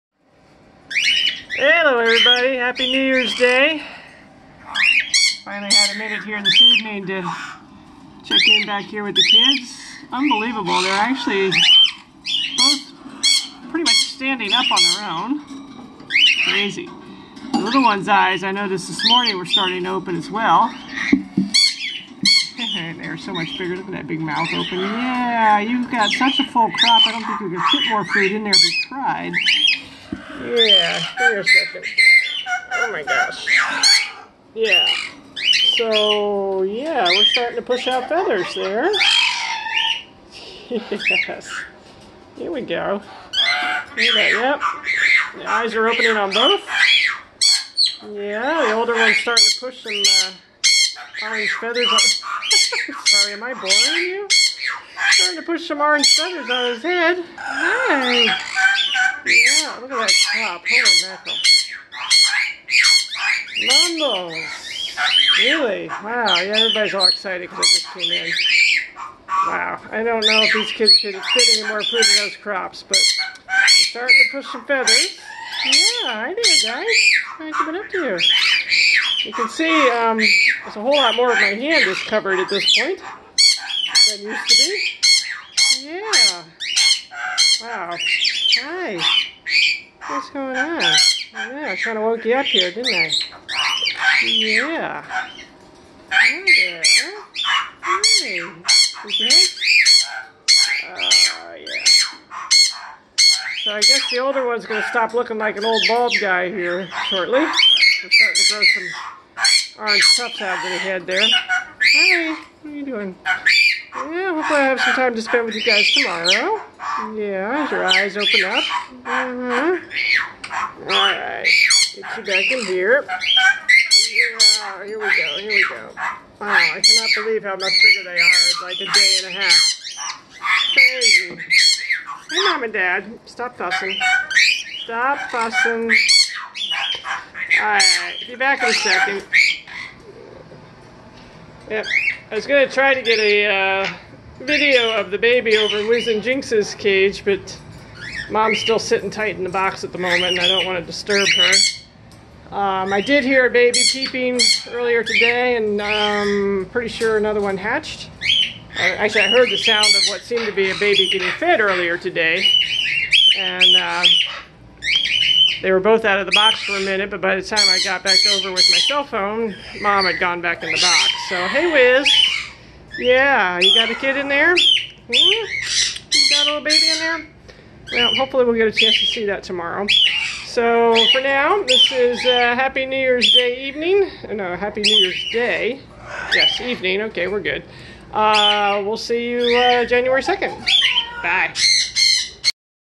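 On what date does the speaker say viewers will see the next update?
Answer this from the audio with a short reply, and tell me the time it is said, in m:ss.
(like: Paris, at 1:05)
January 2, at 3:09.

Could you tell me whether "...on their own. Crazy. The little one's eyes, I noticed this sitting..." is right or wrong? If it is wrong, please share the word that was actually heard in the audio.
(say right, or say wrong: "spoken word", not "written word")
wrong: "morning", not "sitting".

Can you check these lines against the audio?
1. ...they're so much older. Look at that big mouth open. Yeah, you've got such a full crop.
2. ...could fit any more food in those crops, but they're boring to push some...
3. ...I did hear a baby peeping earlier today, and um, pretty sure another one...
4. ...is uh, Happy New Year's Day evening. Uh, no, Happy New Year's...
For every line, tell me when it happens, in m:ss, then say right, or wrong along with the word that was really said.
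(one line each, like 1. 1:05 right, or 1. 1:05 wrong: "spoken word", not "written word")
1. 0:22 wrong: "bigger", not "older"
2. 1:10 wrong: "starting", not "boring"
3. 2:32 right
4. 3:01 right.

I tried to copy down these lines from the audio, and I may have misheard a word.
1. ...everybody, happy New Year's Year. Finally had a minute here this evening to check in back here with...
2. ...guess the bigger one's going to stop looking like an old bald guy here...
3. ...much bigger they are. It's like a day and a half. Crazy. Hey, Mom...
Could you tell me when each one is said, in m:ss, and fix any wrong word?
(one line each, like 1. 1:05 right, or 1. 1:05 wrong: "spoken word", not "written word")
1. 0:02 wrong: "Day", not "Year"
2. 1:43 wrong: "older", not "bigger"
3. 2:07 right.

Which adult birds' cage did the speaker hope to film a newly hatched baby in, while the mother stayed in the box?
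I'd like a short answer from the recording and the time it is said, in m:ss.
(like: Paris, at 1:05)
Wiz and Jinx, at 2:25.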